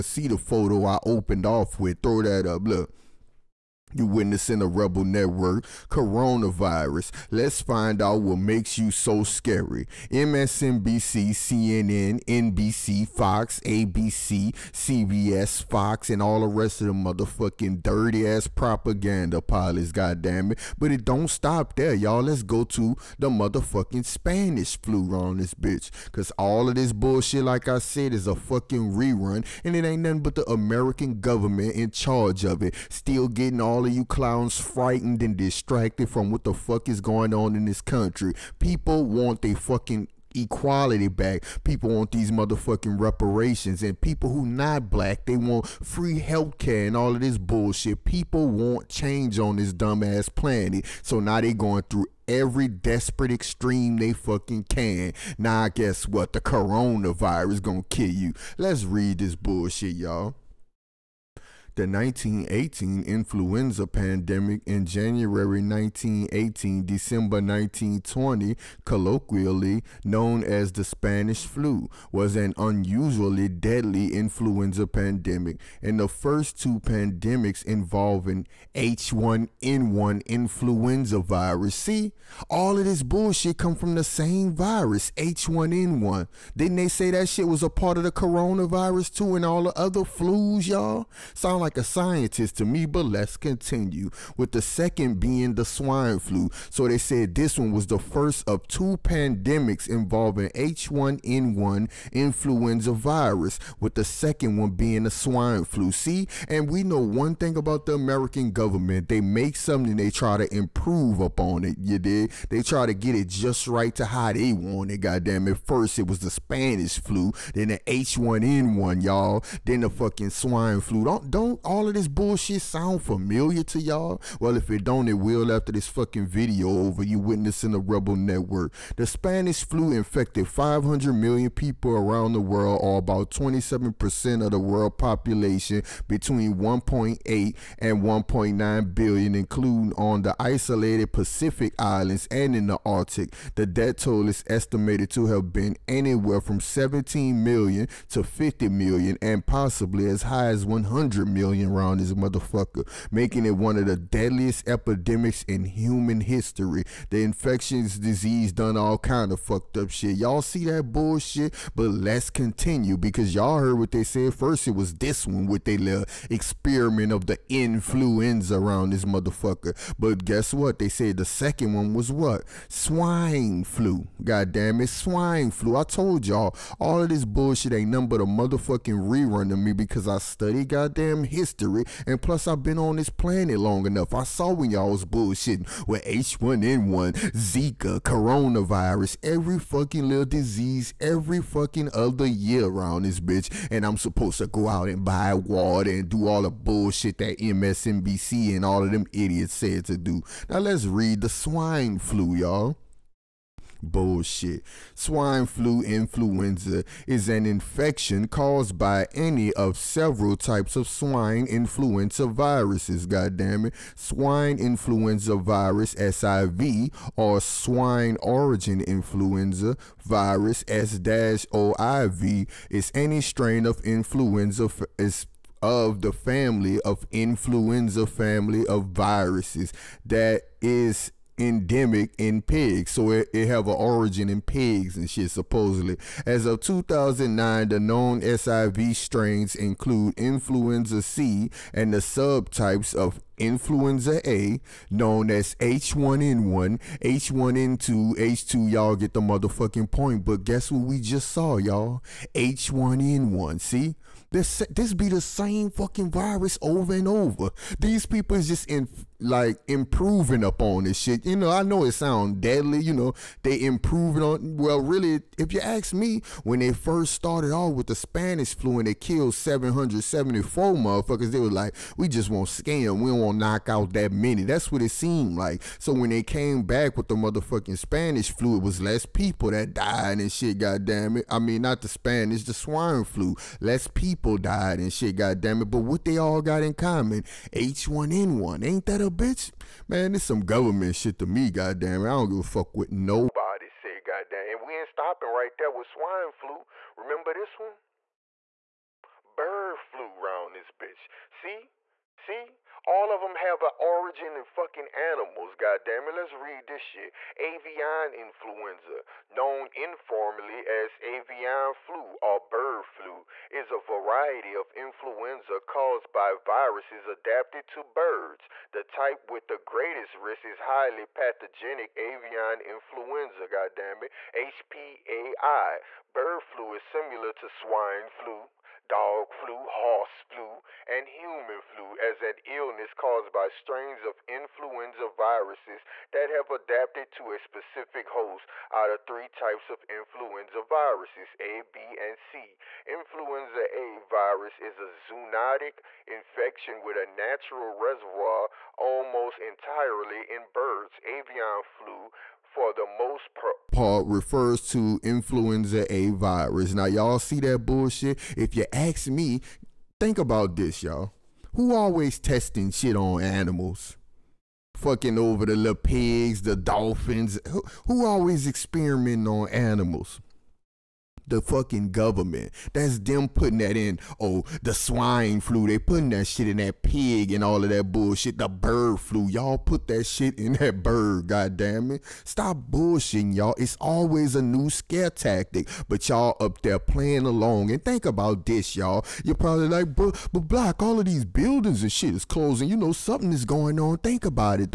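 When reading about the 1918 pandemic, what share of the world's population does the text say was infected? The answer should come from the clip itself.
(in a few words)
27%.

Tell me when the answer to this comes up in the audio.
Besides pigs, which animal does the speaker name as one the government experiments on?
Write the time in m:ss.
6:06.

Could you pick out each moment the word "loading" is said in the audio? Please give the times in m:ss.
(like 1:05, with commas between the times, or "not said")
not said.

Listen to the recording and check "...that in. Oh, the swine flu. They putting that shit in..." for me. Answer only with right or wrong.
right.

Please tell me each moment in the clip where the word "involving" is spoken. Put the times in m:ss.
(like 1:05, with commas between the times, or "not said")
1:17, 1:39.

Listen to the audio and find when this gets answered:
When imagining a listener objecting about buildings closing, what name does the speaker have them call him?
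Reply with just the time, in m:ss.
6:30.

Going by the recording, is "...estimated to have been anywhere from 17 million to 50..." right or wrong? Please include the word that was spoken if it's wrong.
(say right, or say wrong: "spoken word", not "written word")
right.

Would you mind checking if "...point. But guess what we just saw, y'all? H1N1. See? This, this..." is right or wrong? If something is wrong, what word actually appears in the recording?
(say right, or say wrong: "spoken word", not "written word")
right.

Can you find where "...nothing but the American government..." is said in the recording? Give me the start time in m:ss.
0:30.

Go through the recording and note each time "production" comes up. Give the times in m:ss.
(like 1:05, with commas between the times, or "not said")
not said.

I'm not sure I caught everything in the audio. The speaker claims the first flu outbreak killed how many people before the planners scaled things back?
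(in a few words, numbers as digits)
774.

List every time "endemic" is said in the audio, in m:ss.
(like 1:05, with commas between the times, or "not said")
3:51.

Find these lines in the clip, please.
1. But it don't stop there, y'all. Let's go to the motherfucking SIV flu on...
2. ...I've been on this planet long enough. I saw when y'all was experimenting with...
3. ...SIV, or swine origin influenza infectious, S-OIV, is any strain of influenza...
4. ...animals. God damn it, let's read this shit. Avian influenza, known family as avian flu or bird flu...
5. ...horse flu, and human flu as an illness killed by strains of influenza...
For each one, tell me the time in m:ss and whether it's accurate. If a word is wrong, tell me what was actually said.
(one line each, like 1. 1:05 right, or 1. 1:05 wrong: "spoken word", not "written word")
1. 0:20 wrong: "Spanish", not "SIV"
2. 3:02 wrong: "bullshitting", not "experimenting"
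3. 3:35 wrong: "virus", not "infectious"
4. 5:04 wrong: "informally", not "family"
5. 5:29 wrong: "caused", not "killed".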